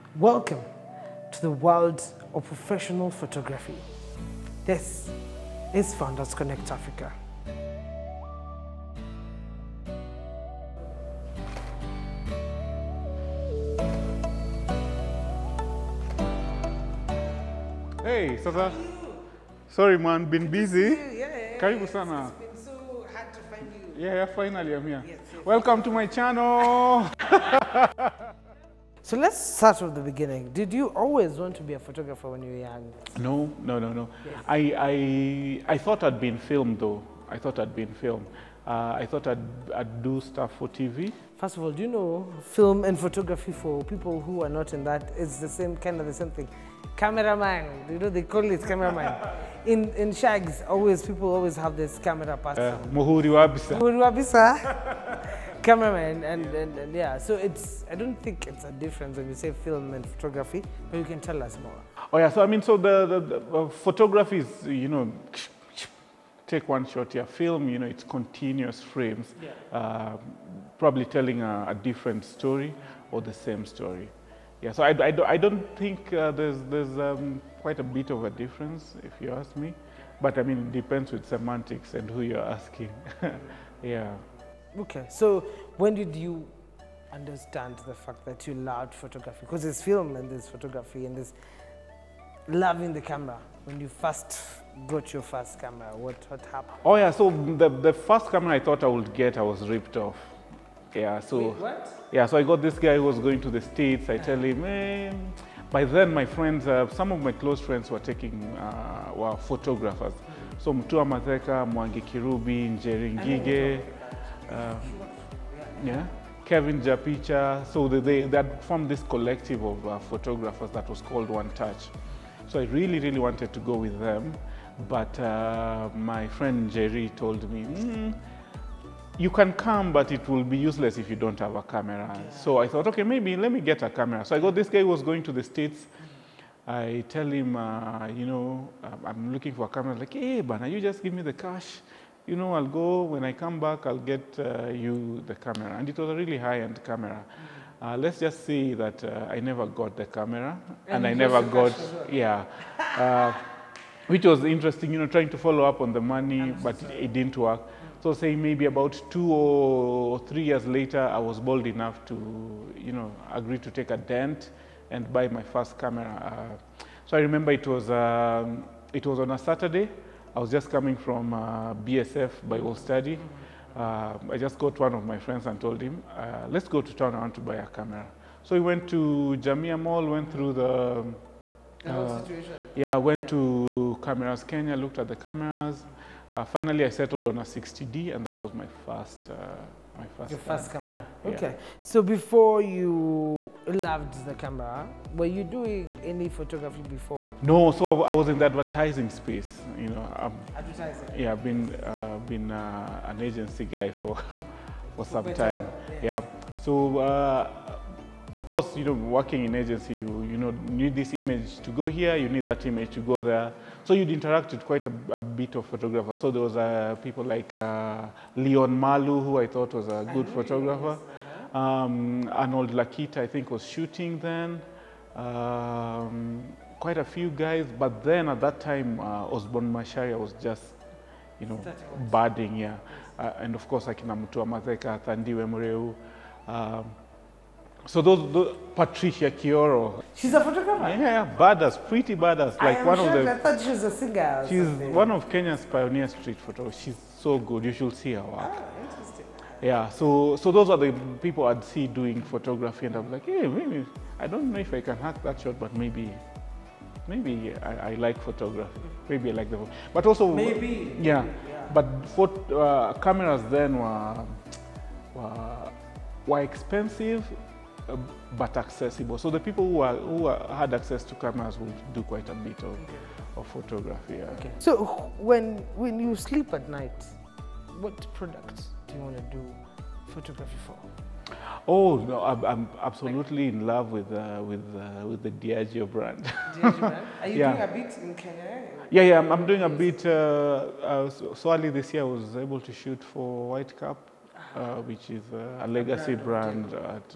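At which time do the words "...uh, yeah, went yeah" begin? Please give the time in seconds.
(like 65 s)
181 s.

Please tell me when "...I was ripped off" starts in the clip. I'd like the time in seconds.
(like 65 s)
99 s.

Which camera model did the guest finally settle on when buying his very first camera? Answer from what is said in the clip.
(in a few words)
60D.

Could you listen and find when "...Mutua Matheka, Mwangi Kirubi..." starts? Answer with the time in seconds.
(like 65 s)
110 s.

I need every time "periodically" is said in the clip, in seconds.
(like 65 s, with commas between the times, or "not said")
not said.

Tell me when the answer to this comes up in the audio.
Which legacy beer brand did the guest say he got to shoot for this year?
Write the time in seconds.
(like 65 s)
293 s.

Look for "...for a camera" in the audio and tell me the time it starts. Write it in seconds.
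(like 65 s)
139 s.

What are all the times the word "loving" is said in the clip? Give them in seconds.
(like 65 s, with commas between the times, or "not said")
92 s.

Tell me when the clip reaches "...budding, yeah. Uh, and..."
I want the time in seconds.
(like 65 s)
232 s.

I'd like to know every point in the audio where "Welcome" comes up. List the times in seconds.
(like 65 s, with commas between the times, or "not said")
0 s, 25 s.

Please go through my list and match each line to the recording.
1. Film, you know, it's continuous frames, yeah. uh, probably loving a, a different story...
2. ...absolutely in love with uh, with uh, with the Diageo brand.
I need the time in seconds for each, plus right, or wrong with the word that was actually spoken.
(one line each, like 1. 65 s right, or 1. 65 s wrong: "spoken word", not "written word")
1. 67 s wrong: "telling", not "loving"
2. 282 s right.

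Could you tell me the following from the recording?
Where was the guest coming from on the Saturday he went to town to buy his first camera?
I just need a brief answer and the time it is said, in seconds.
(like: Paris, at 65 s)
BSF Bible study, at 171 s.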